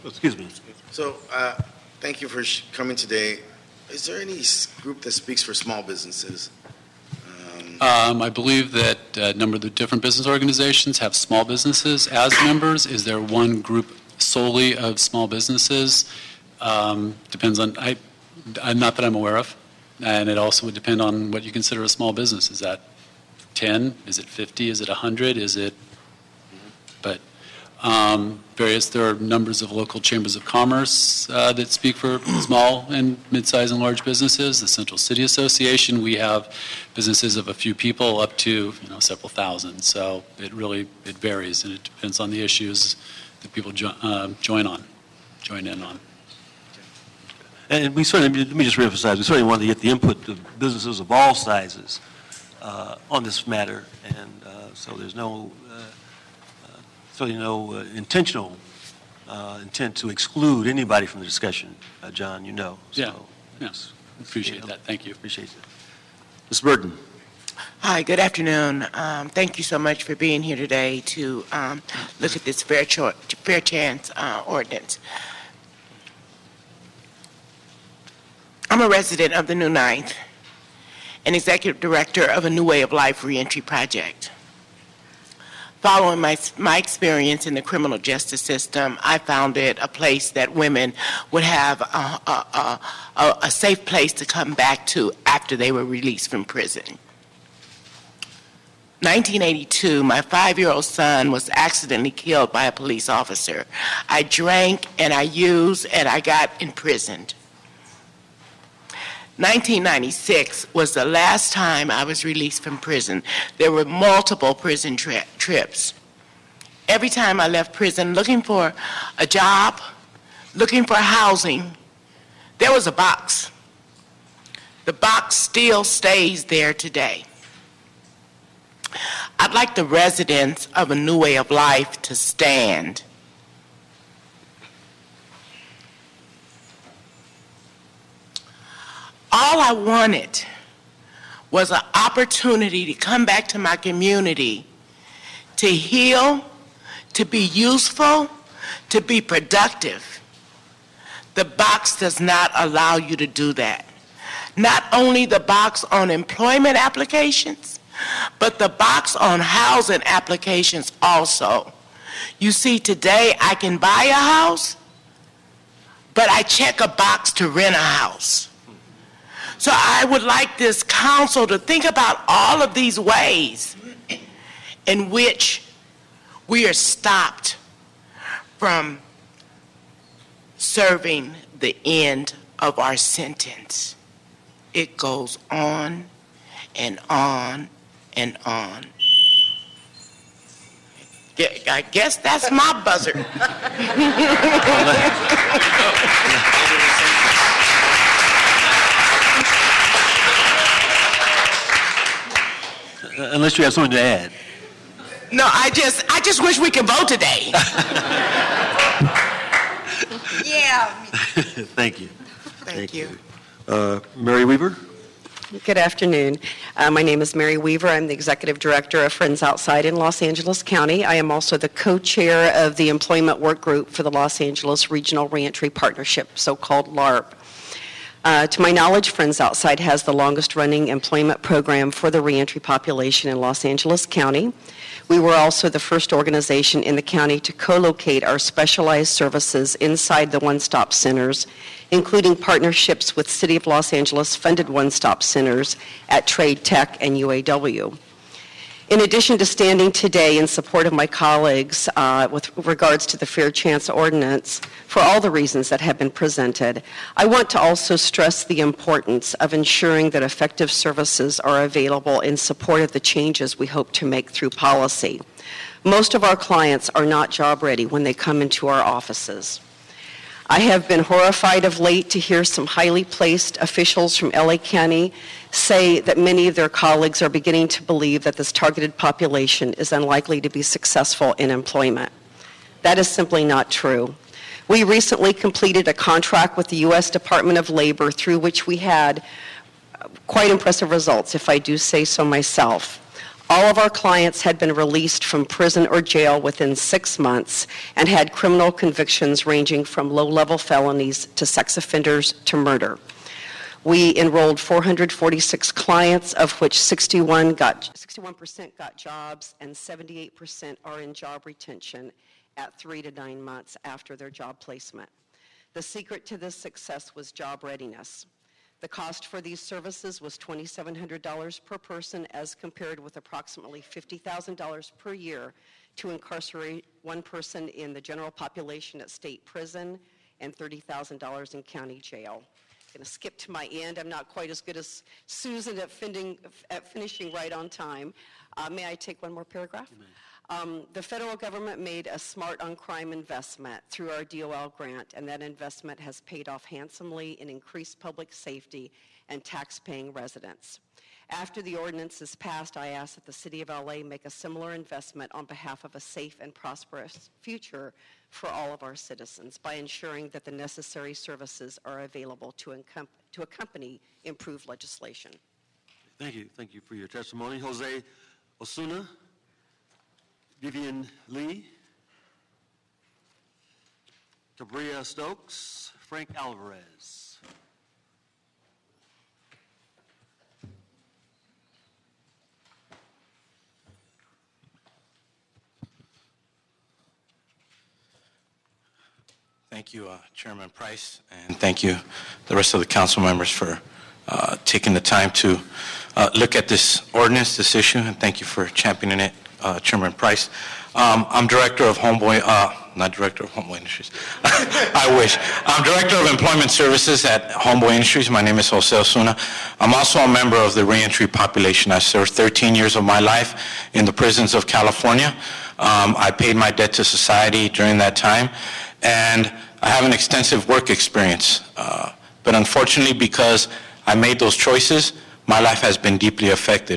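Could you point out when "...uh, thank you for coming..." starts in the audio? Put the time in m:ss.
0:01.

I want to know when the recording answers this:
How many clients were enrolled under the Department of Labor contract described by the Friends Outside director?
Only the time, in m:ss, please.
5:04.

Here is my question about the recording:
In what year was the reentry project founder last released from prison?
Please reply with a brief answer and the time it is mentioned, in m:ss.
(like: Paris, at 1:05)
1996, at 1:49.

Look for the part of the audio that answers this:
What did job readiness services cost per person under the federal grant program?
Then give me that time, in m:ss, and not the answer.
5:20.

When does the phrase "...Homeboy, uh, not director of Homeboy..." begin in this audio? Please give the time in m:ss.
6:41.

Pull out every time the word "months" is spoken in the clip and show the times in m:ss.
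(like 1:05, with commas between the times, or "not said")
4:57, 5:13.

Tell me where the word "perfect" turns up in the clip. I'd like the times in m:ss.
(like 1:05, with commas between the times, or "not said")
not said.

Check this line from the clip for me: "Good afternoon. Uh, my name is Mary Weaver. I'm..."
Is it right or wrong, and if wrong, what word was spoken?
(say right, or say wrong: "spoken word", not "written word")
right.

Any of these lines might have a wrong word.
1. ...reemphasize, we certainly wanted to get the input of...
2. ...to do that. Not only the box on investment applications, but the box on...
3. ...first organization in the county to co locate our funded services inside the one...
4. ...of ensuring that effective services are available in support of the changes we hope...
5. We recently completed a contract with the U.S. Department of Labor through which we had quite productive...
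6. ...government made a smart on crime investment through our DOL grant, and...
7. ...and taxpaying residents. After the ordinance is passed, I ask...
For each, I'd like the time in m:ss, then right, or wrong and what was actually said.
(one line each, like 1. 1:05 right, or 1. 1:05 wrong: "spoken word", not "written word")
1. 0:48 right
2. 2:33 wrong: "employment", not "investment"
3. 3:55 wrong: "specialized", not "funded"
4. 4:19 right
5. 4:44 wrong: "impressive", not "productive"
6. 5:41 right
7. 5:49 right.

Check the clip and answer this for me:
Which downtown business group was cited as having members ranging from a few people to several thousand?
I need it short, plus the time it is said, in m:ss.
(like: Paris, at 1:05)
Central City Association, at 0:34.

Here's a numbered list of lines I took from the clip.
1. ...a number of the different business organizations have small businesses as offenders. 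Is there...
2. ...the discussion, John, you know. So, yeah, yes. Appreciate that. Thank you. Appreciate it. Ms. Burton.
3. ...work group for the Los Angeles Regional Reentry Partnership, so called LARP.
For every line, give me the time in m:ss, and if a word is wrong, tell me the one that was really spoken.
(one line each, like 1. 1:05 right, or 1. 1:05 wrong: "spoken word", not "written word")
1. 0:09 wrong: "members", not "offenders"
2. 1:01 right
3. 3:43 right.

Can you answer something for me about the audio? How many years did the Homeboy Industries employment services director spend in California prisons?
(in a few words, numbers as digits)
13 years.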